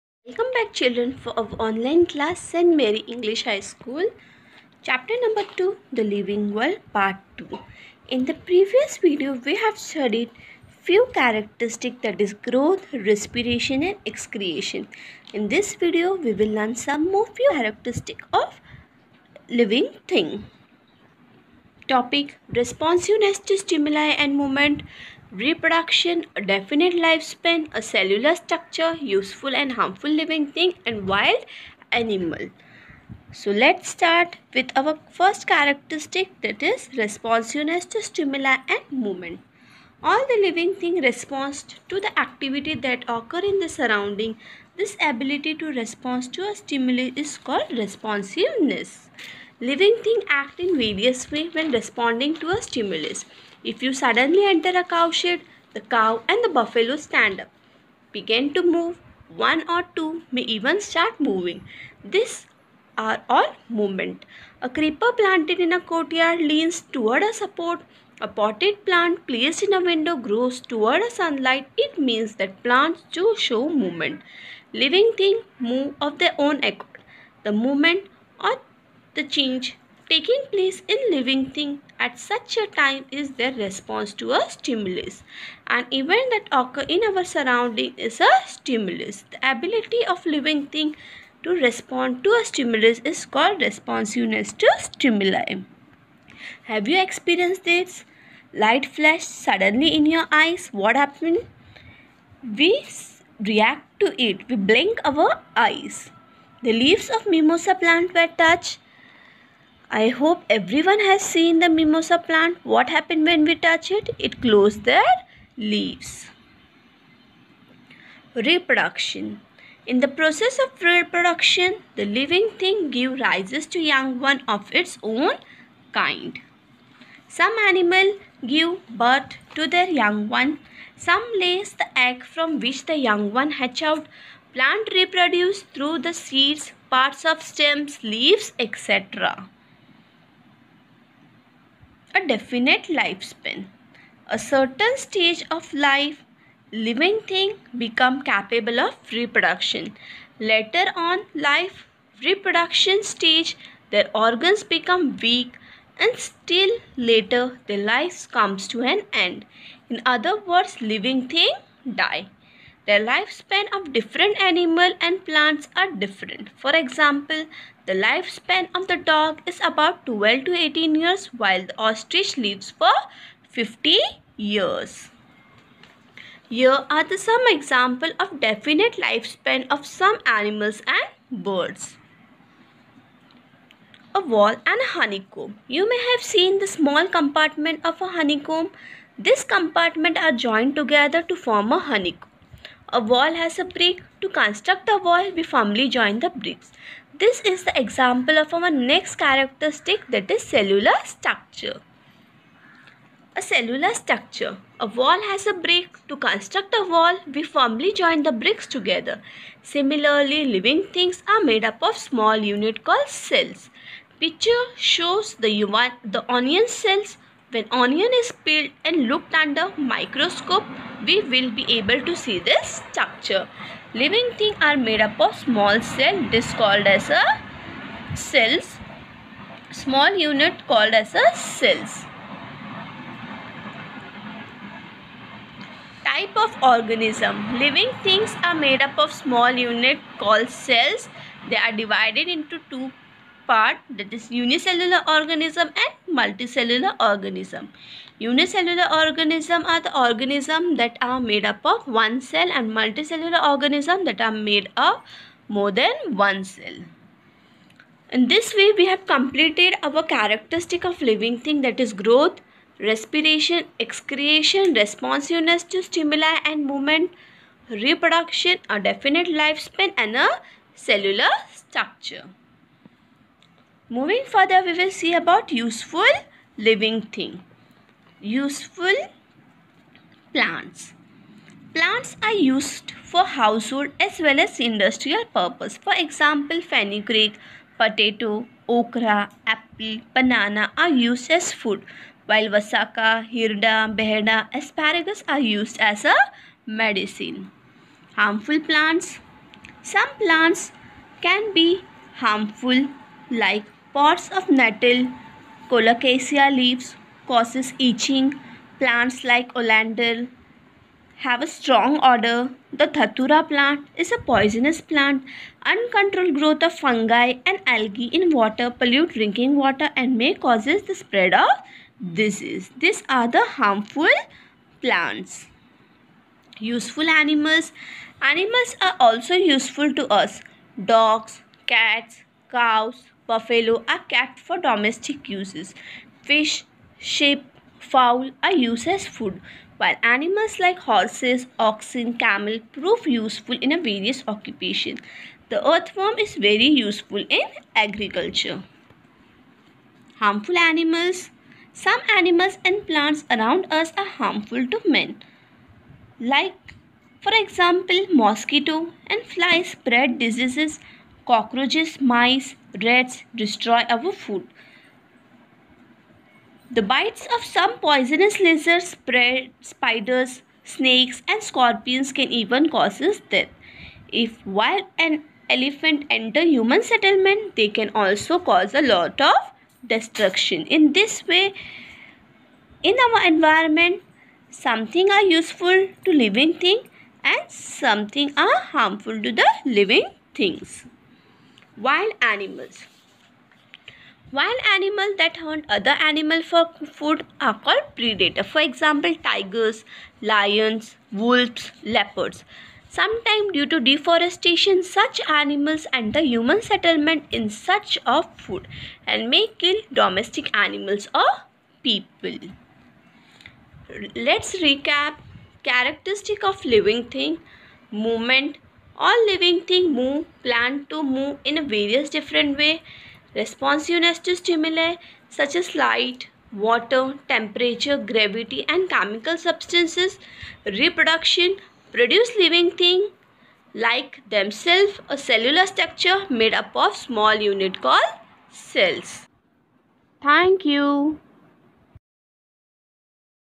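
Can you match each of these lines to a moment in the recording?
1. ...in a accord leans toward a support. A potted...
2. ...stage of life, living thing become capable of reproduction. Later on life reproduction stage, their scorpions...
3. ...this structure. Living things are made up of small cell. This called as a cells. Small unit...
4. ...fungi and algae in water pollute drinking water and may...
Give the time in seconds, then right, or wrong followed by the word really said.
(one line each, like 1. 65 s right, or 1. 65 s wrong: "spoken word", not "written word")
1. 65 s wrong: "courtyard", not "accord"
2. 144 s wrong: "organs", not "scorpions"
3. 222 s right
4. 316 s right.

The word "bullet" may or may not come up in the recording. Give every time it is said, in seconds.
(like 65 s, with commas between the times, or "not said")
not said.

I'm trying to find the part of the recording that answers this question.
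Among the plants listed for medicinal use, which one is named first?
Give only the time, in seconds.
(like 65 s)
292 s.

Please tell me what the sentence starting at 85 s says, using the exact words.
An event that occurs in our surrounding is a stimulus.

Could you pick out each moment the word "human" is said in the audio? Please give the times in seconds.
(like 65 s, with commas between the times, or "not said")
376 s, 406 s.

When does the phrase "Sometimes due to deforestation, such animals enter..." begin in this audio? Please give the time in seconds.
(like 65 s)
402 s.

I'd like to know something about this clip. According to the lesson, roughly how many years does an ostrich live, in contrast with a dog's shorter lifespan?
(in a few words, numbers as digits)
50 years.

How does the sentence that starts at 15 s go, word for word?
In this video we will learn some more few characteristics of living thing.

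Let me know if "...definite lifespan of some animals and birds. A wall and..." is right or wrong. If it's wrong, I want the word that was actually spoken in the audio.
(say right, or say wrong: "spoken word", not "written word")
right.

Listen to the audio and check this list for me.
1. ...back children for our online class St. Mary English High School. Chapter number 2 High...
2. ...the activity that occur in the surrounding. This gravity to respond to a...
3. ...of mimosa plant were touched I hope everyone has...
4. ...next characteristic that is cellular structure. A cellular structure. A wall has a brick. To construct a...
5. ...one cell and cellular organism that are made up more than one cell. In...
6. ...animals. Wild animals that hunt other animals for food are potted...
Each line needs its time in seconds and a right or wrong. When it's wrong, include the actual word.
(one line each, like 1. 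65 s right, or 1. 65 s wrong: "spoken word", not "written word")
1. 0 s wrong: "The", not "High"
2. 42 s wrong: "ability", not "gravity"
3. 107 s right
4. 198 s right
5. 251 s wrong: "multicellular", not "cellular"
6. 392 s wrong: "called", not "potted".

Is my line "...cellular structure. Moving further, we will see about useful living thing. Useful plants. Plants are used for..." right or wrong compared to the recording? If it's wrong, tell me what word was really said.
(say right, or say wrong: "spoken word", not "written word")
right.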